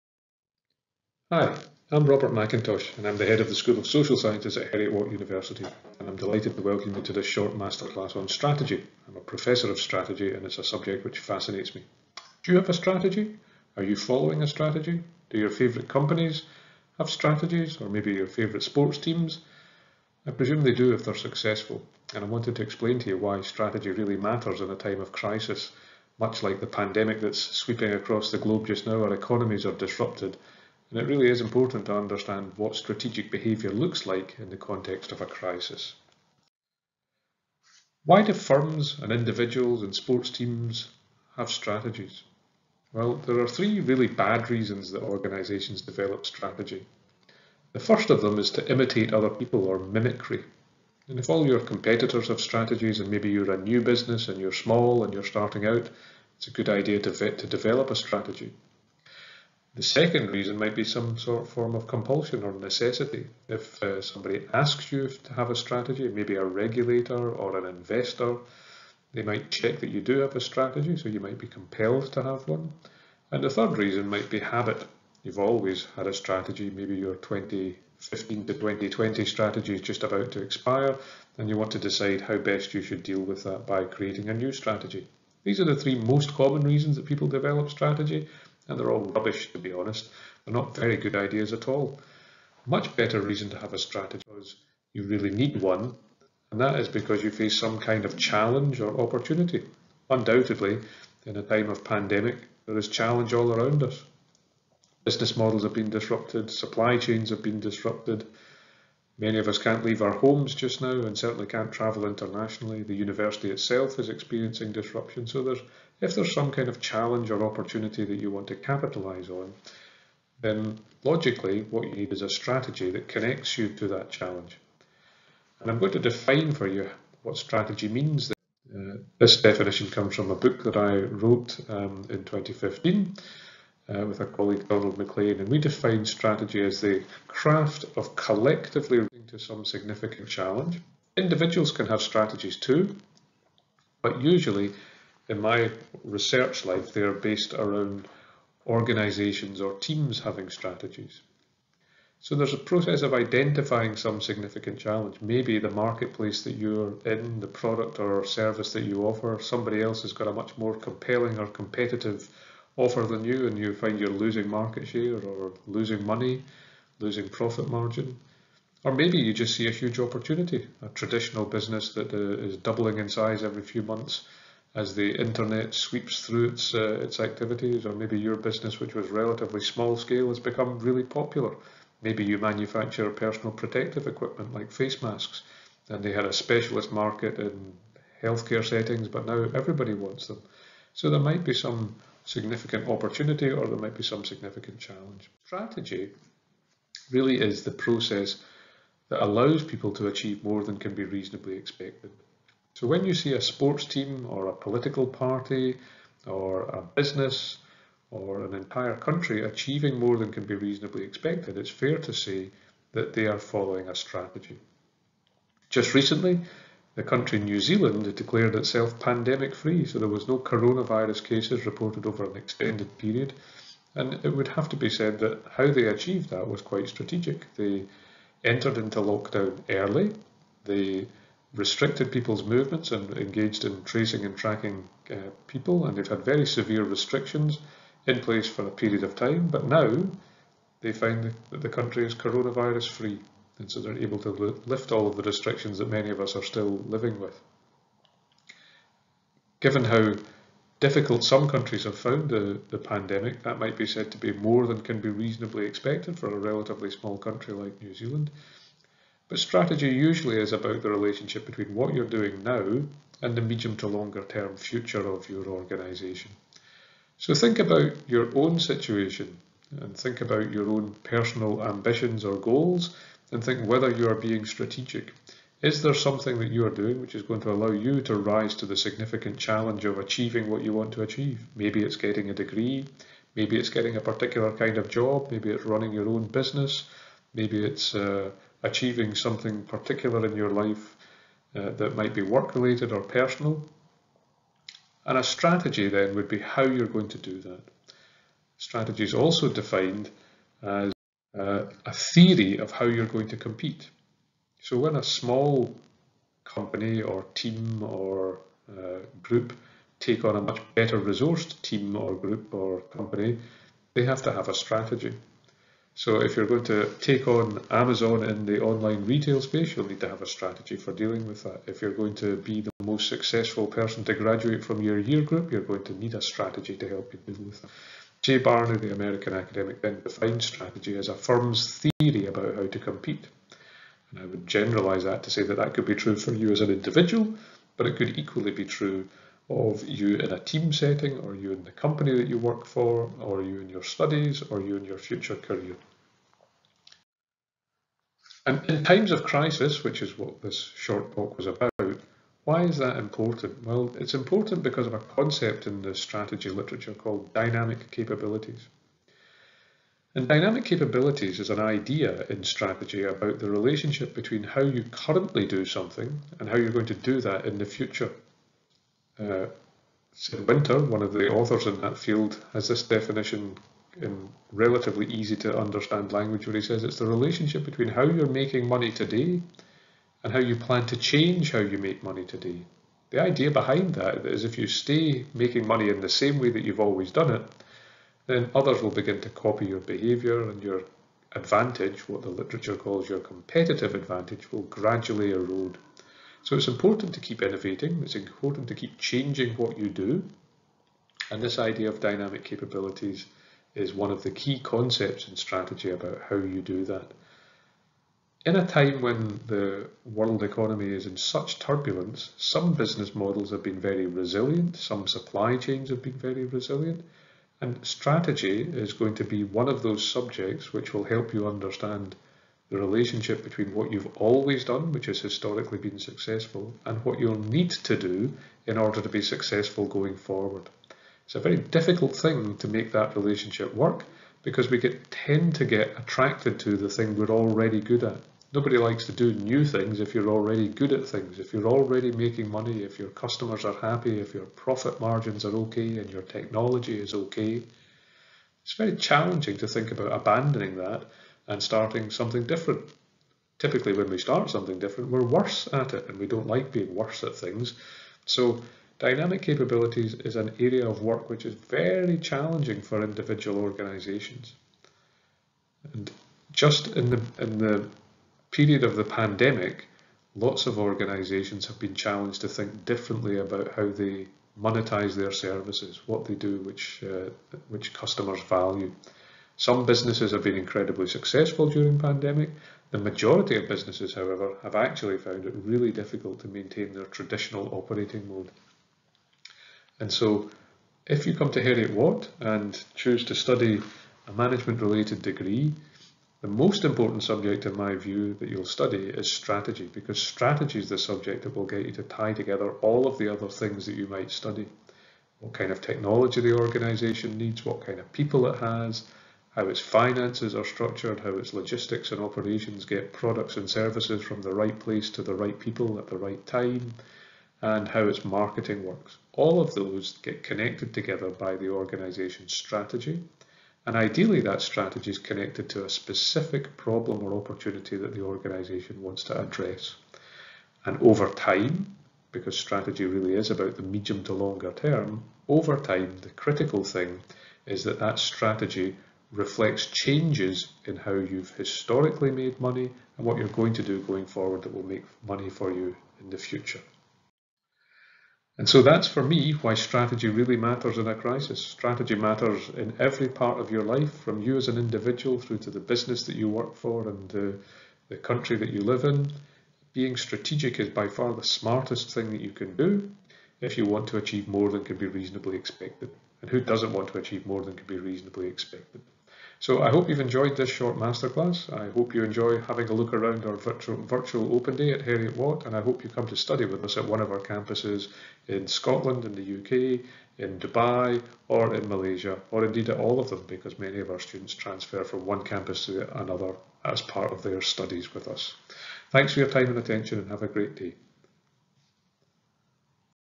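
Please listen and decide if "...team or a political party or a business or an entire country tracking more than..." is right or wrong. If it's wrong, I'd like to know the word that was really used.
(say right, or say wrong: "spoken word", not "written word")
wrong: "achieving", not "tracking".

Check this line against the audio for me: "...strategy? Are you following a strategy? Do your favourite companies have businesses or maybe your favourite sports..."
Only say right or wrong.
wrong.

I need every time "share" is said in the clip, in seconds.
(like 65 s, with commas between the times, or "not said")
164 s.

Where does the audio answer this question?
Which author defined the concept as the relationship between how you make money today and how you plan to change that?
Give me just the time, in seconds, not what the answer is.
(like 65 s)
370 s.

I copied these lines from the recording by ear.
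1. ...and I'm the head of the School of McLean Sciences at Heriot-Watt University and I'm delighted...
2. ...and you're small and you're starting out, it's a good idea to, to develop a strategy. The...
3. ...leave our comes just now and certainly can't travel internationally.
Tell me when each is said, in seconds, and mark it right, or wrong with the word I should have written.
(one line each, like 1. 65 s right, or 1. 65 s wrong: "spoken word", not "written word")
1. 2 s wrong: "Social", not "McLean"
2. 54 s right
3. 109 s wrong: "homes", not "comes".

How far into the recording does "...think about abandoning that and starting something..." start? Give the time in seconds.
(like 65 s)
449 s.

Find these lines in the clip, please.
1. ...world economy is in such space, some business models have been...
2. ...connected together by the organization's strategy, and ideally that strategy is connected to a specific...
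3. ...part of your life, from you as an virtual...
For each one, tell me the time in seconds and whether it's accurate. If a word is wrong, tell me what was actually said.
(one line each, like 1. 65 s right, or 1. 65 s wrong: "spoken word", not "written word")
1. 410 s wrong: "turbulence", not "space"
2. 520 s right
3. 553 s wrong: "individual", not "virtual".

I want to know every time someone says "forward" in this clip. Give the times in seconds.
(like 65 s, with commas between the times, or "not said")
430 s, 544 s.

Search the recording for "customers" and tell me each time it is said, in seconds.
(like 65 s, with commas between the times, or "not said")
443 s, 477 s.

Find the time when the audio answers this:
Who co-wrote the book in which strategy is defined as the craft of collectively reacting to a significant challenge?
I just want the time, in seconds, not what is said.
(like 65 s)
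134 s.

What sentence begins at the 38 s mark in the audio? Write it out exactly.
Why do firms and individuals and sports teams have strategies?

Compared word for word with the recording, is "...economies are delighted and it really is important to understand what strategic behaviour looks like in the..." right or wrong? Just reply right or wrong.
wrong.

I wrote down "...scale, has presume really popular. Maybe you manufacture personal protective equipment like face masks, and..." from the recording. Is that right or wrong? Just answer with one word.
wrong.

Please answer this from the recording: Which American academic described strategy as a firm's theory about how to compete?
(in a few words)
Jay Barney.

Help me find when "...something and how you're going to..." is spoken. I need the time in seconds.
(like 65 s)
365 s.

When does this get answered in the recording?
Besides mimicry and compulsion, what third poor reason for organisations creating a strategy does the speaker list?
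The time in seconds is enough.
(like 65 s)
74 s.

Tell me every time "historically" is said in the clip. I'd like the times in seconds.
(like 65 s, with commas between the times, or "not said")
425 s, 541 s.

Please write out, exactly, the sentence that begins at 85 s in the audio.
These are the three most common reasons that people develop strategy, and they're all rubbish to be honest.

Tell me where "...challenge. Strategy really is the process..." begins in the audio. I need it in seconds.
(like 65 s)
194 s.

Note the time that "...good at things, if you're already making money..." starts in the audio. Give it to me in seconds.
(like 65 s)
440 s.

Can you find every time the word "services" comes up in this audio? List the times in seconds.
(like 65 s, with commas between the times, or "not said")
158 s, 475 s, 513 s.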